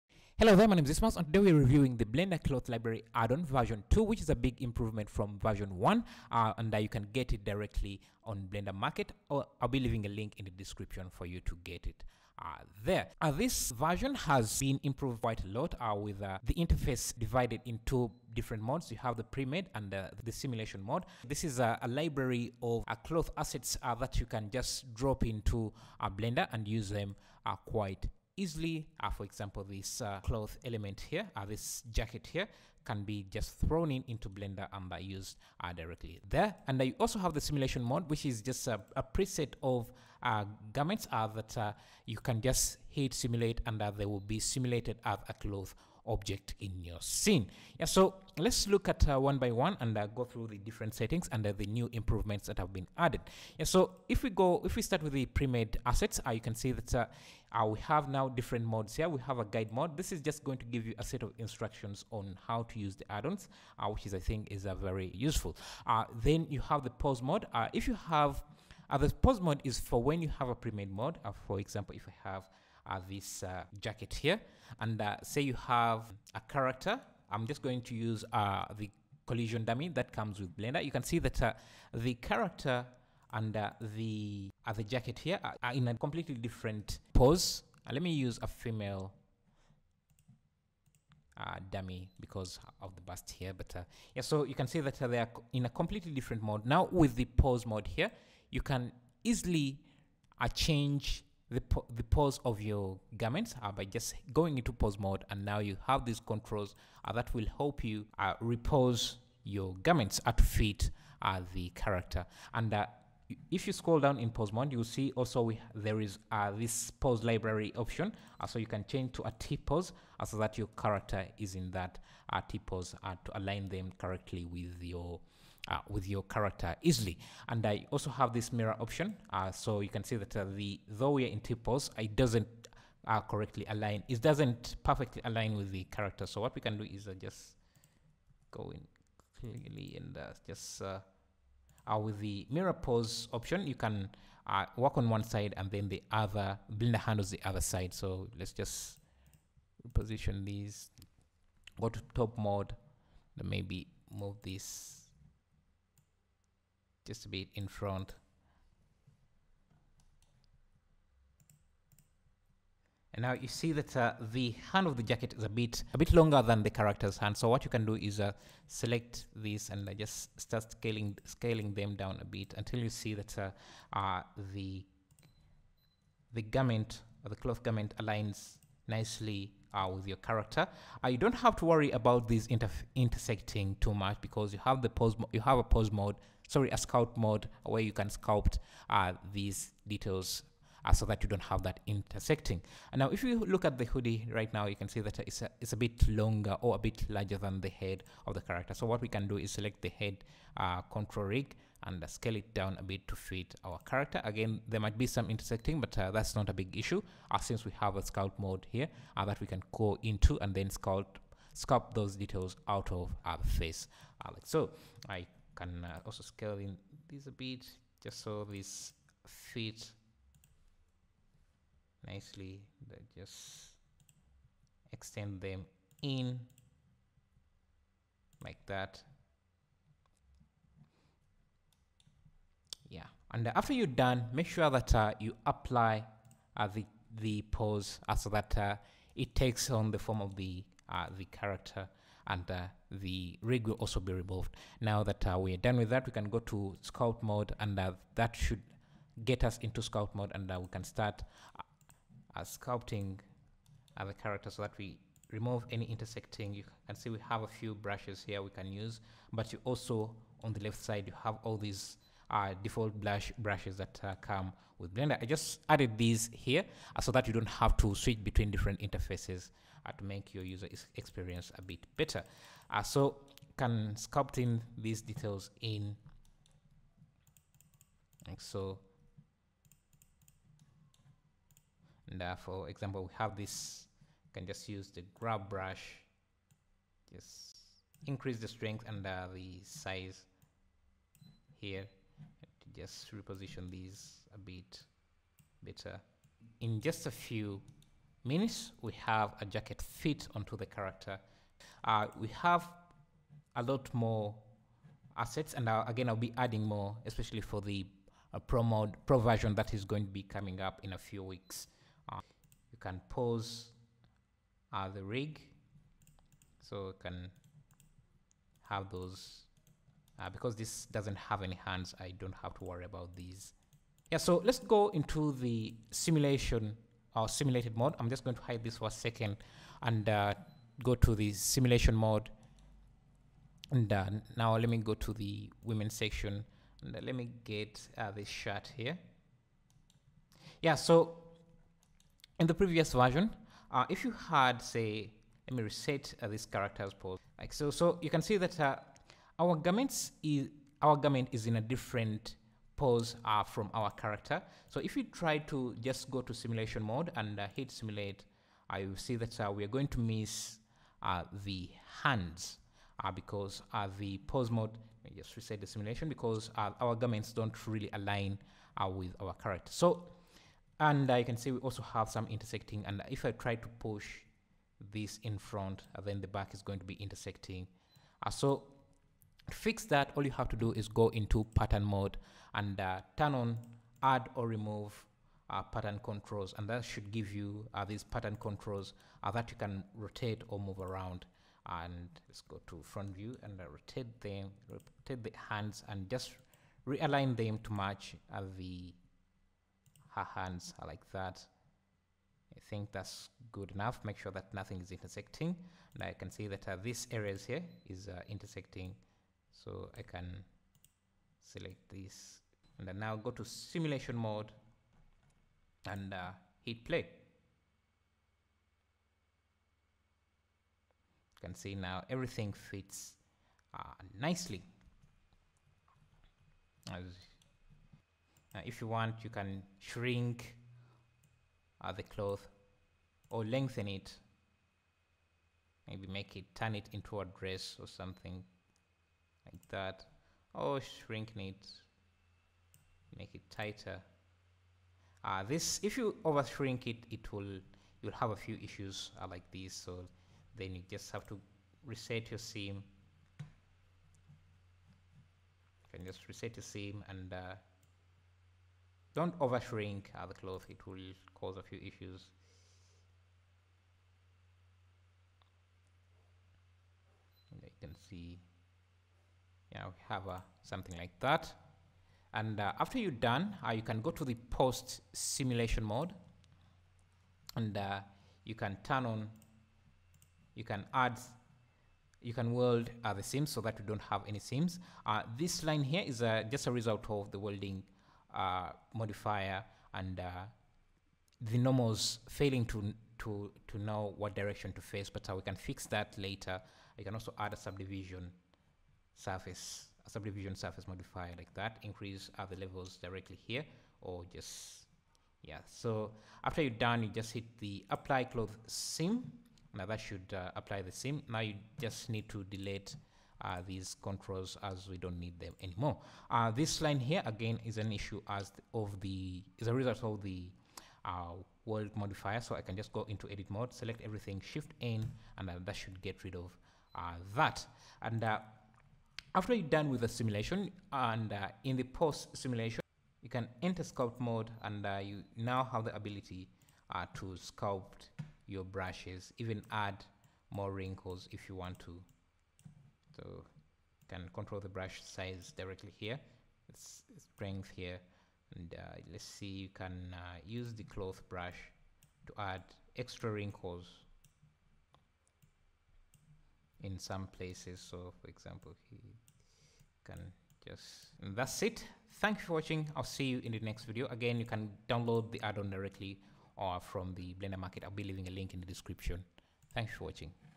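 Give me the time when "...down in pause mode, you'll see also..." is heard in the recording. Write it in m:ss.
1:53.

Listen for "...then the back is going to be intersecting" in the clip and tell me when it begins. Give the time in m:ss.
6:16.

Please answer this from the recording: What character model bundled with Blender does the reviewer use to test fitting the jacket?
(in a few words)
collision dummy.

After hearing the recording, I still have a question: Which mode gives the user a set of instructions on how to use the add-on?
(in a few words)
guide mode.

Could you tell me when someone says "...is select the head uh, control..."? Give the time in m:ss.
3:19.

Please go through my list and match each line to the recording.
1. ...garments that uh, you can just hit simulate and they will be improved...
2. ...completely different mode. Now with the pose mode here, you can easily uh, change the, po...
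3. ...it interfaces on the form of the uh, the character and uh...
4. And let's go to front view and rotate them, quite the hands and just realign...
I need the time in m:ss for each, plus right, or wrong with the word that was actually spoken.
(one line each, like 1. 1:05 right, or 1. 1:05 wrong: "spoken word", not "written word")
1. 0:40 wrong: "simulated", not "improved"
2. 1:35 right
3. 3:59 wrong: "takes", not "interfaces"
4. 6:31 wrong: "rotate", not "quite".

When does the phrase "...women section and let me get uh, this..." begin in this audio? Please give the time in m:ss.
5:35.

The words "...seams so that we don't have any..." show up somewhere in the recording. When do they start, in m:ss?
8:03.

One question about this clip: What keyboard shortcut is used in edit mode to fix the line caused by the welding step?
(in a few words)
Shift N.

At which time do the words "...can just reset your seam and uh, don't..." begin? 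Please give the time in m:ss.
7:35.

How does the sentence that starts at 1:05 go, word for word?
Uh, then you have the pause mode.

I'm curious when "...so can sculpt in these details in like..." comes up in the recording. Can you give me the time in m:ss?
4:32.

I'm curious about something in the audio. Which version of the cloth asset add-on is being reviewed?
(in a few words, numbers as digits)
2.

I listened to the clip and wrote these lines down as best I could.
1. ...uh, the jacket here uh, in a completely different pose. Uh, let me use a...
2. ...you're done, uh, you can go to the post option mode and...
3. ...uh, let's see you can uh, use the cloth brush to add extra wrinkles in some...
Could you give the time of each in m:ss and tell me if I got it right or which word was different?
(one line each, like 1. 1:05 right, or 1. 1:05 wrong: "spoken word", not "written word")
1. 1:24 right
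2. 7:52 wrong: "simulation", not "option"
3. 9:08 right.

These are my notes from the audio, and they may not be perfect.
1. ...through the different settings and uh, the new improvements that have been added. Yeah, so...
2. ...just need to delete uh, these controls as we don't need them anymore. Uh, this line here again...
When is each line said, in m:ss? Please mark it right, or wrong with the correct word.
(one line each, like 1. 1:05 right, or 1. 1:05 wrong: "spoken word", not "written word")
1. 0:50 right
2. 8:31 right.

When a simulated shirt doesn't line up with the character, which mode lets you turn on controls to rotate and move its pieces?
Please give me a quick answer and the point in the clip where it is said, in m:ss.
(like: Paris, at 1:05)
pattern mode, at 6:21.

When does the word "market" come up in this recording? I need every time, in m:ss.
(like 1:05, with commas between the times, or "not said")
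0:08, 9:27.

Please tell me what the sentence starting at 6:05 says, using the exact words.
Let me just reset the simulation because our garments don't really align with our character.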